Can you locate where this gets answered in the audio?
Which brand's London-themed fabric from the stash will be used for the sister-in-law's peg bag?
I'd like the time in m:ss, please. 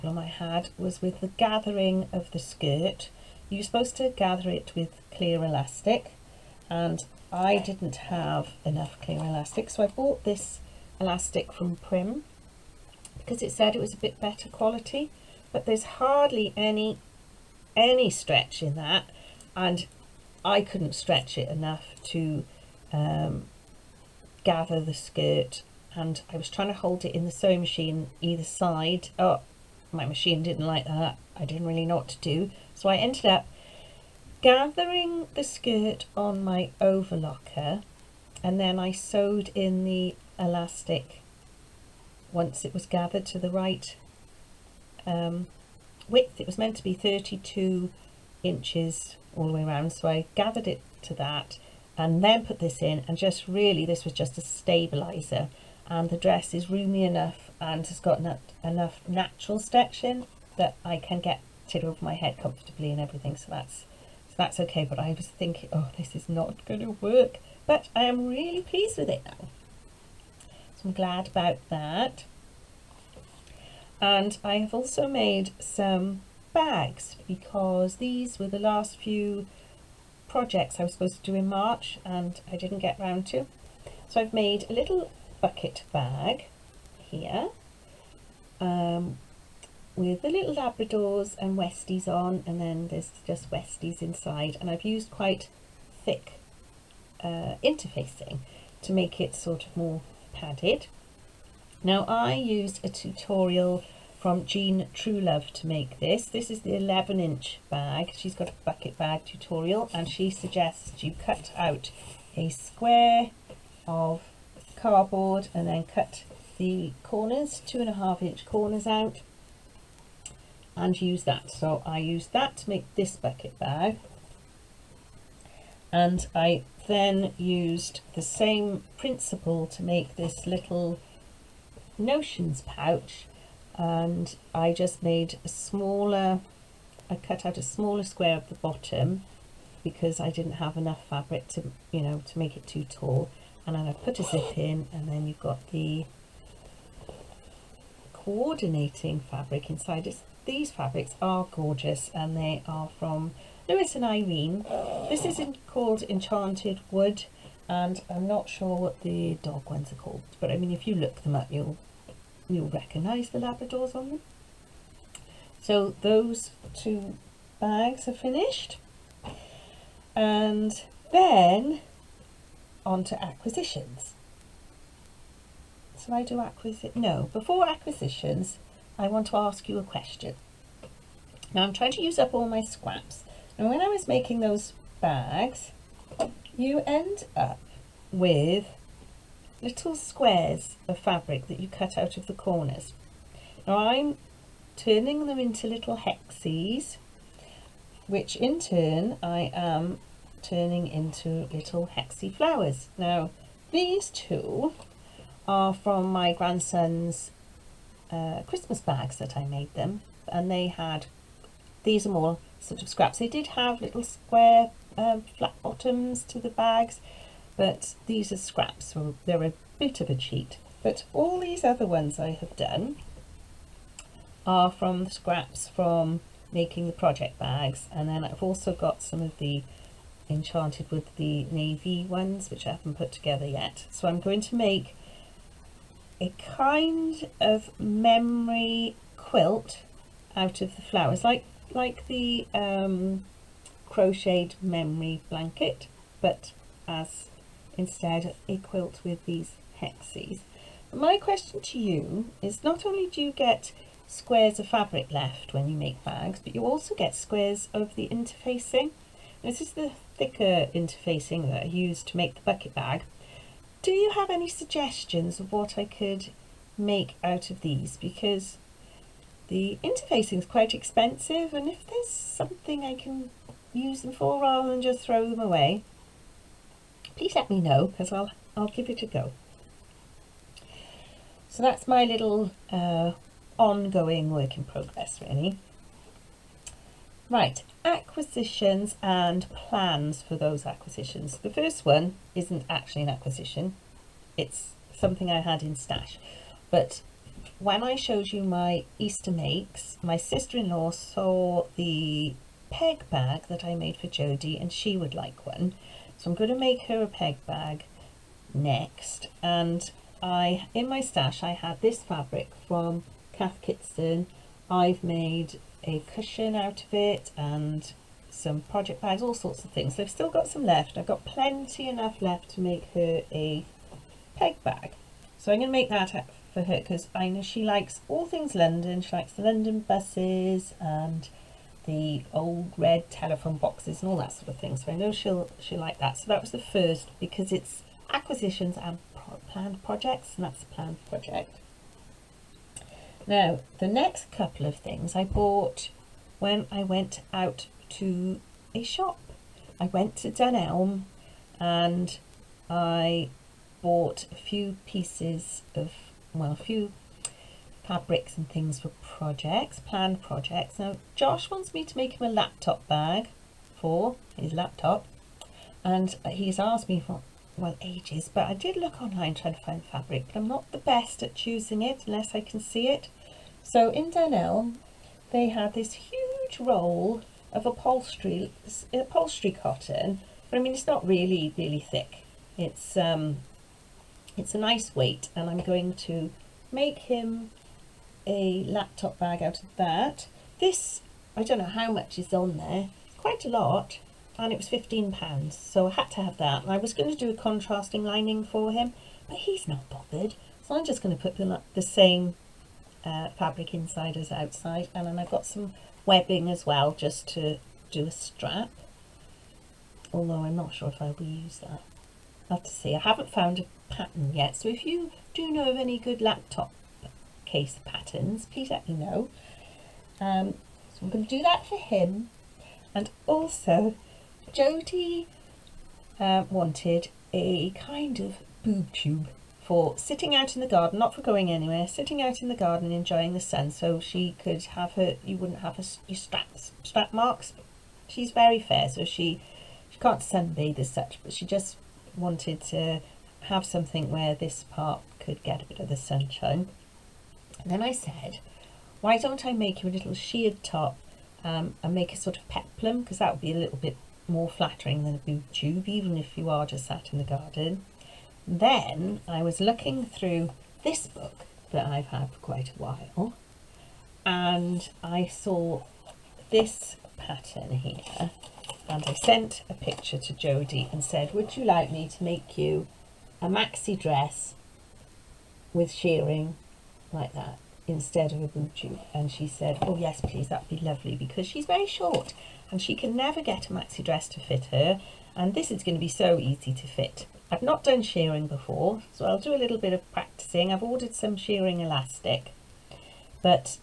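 5:13.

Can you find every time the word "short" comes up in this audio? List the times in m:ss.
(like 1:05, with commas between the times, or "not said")
8:01.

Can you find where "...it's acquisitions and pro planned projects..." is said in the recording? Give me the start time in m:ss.
5:37.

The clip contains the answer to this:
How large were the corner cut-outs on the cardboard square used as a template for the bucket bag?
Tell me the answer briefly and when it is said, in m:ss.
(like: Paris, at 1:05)
2.5 inch, at 1:57.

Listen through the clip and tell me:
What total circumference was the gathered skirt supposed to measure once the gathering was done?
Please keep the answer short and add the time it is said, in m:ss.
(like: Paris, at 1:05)
32 inches, at 0:46.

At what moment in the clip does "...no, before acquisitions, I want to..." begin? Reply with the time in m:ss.
2:56.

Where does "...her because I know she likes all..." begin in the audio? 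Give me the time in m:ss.
5:26.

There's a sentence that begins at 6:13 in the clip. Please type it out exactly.
So in Dunelm, they had this huge roll of upholstery, upholstery cotton, but I mean, it's not really, really thick.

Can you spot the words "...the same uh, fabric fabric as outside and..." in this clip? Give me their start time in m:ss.
6:41.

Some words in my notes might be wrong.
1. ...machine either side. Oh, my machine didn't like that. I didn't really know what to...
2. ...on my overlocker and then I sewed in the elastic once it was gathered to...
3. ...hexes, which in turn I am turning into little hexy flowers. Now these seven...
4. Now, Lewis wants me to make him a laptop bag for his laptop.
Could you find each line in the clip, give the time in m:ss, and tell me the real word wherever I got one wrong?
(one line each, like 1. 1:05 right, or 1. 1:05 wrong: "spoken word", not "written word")
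1. 0:27 right
2. 0:36 right
3. 3:15 wrong: "two", not "seven"
4. 6:00 wrong: "Josh", not "Lewis".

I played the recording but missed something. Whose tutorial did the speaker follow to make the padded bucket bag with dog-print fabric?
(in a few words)
Jean Truelove.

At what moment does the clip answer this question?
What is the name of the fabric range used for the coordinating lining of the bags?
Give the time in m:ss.
2:36.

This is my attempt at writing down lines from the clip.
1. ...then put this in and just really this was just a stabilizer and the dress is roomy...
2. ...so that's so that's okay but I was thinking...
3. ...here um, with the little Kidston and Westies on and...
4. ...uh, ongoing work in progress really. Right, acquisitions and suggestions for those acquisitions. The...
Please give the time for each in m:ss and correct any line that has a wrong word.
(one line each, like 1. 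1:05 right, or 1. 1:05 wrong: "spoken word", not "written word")
1. 0:52 right
2. 1:03 right
3. 1:27 wrong: "Labradors", not "Kidston"
4. 4:42 wrong: "plans", not "suggestions".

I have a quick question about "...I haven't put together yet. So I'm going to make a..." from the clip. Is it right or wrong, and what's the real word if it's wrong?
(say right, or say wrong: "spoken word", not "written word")
right.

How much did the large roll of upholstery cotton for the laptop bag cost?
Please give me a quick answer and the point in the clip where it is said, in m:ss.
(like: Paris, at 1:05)
£15, at 6:34.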